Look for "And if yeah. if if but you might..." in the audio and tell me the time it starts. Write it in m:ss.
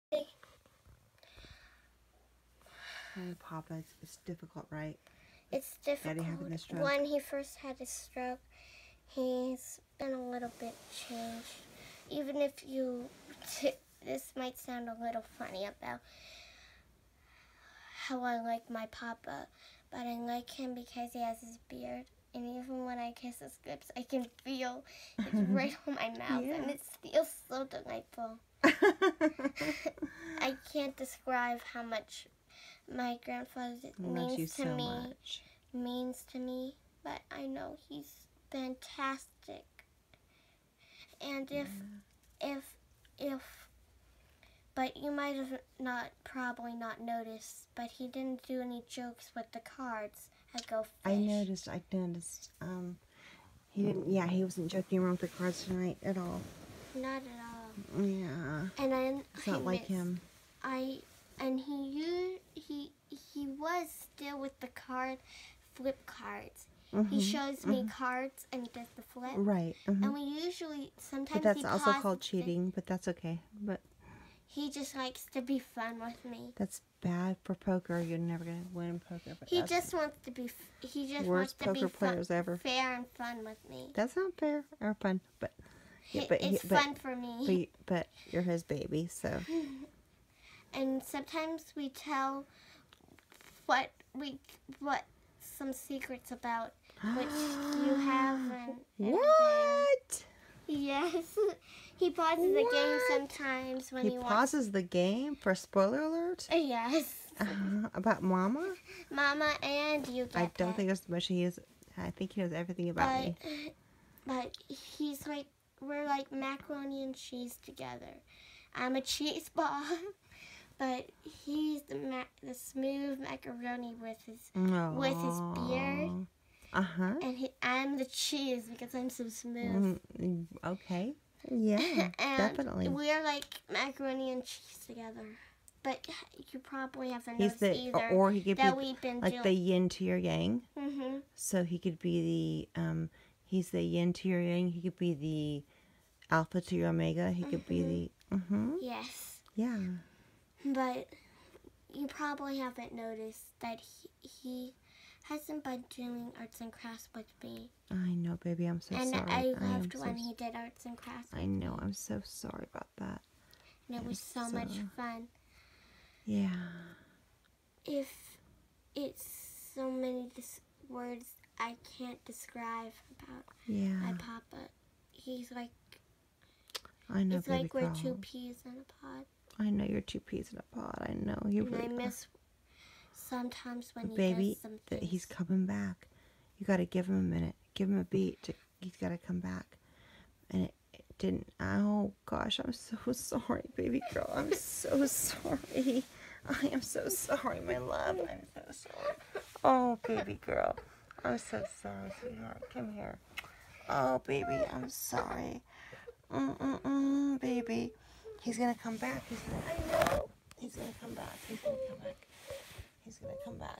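0:41.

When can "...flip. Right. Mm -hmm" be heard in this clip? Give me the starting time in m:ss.
1:09.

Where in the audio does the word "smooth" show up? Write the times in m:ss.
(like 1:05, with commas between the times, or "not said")
2:02, 2:09.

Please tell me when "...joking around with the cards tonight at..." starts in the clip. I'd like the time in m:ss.
0:54.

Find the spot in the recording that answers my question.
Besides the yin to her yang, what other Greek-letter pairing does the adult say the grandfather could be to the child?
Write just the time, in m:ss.
2:26.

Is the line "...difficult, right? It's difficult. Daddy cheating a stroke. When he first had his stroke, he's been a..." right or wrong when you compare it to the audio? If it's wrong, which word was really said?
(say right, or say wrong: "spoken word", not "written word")
wrong: "having", not "cheating".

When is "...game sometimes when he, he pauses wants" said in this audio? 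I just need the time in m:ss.
1:42.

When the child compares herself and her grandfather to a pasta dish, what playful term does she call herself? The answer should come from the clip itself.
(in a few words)
cheese ball.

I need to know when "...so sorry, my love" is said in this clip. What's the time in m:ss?
3:16.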